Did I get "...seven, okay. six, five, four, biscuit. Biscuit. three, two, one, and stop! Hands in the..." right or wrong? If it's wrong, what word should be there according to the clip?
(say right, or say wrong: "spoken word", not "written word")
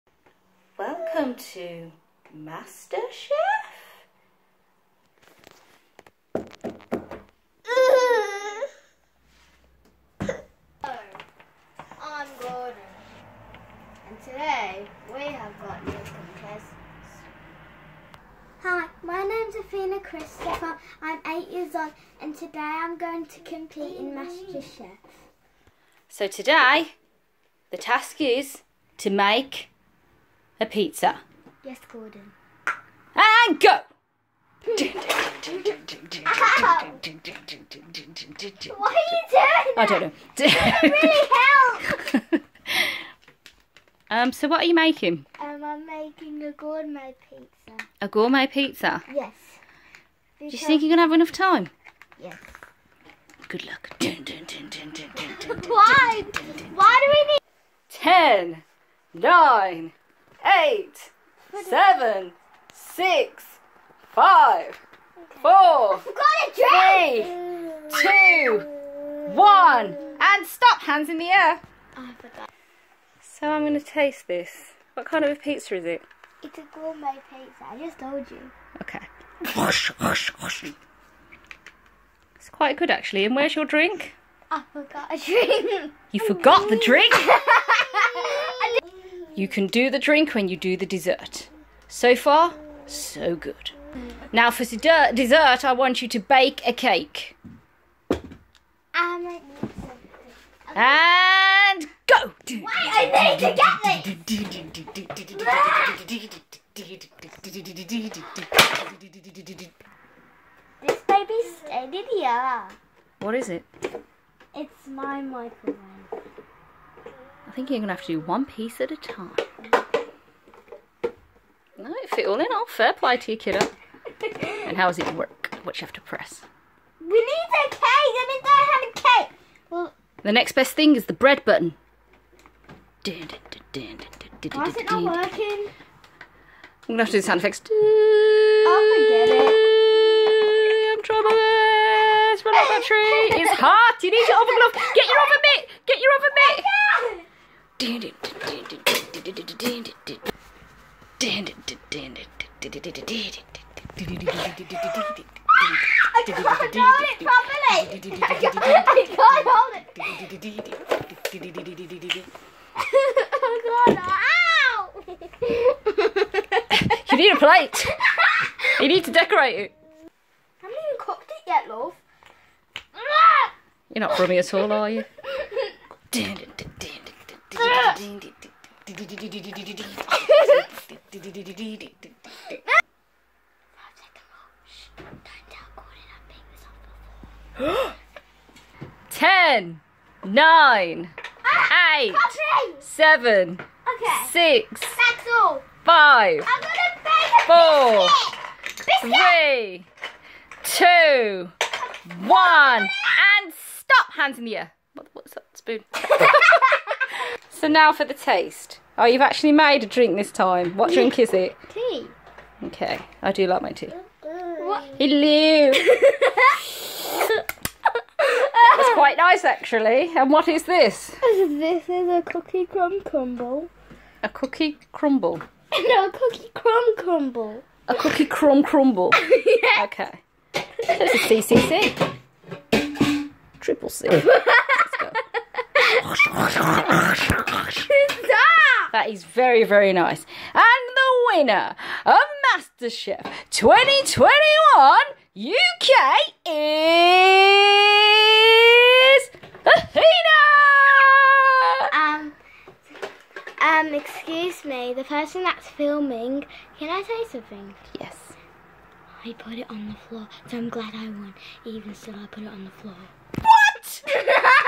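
right.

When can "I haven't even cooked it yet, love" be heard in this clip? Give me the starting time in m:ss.
2:49.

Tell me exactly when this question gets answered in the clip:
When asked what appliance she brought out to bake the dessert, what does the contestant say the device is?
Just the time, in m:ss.
1:55.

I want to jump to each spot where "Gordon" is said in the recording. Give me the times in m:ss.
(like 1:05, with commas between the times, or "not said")
0:12, 0:31.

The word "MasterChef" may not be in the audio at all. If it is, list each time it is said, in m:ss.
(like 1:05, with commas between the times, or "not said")
0:02, 0:24, 4:02.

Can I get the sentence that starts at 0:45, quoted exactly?
Um, I'm making a gourmet pizza.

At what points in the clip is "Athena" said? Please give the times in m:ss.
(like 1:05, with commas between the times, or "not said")
0:19, 4:09.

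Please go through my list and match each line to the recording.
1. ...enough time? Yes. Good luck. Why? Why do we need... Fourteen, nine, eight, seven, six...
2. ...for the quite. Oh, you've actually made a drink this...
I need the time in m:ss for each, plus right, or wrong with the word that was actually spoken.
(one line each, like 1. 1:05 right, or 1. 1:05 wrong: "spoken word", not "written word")
1. 0:51 wrong: "Ten", not "Fourteen"
2. 3:27 wrong: "taste", not "quite".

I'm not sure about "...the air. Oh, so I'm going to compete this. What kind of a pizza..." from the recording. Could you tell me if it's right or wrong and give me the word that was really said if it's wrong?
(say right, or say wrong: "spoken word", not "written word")
wrong: "taste", not "compete".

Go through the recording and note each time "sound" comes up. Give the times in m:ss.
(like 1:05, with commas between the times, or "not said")
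2:17.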